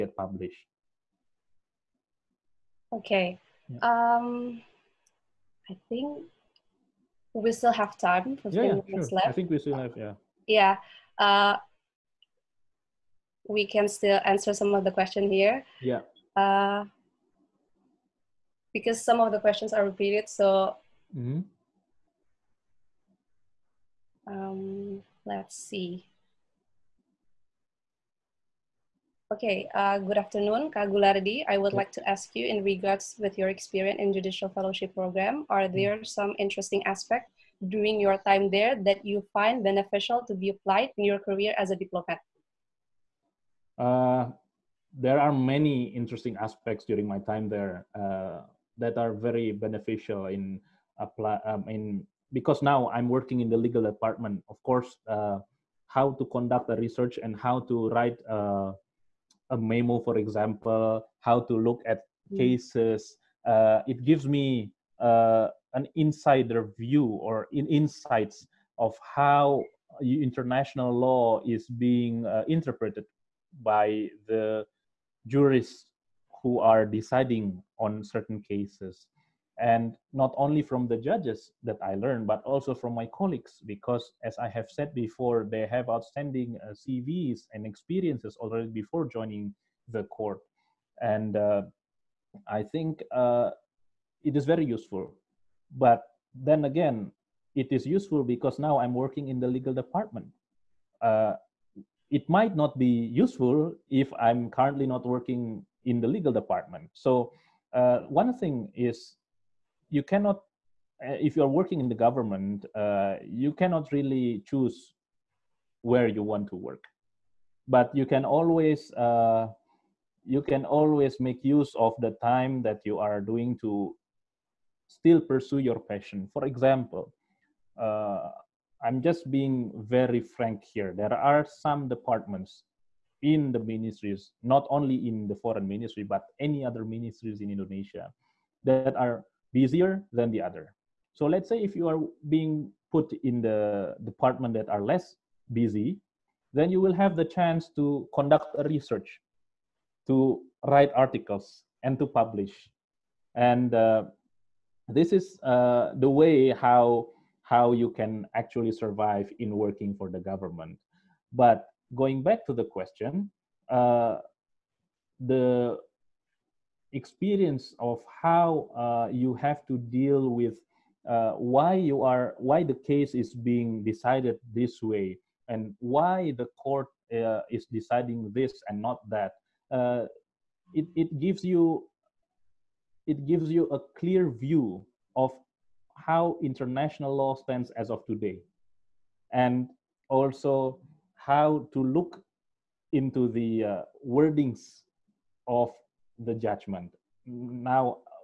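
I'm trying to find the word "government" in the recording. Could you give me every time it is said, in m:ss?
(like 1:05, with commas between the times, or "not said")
1:51, 2:40.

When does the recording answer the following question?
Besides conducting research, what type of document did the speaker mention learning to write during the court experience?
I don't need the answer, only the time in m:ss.
0:59.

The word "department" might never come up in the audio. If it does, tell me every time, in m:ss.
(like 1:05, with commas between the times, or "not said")
0:53, 1:39, 1:46, 2:11, 2:24.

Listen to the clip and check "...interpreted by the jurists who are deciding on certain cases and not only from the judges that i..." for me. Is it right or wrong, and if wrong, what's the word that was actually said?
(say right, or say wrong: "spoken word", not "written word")
right.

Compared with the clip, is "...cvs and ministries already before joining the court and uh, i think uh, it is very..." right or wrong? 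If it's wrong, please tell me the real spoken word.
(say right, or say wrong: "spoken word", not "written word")
wrong: "experiences", not "ministries".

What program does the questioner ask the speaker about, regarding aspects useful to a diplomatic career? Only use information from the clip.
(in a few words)
Judicial fellowship program.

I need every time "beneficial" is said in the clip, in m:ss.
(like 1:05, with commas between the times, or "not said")
0:39, 0:49.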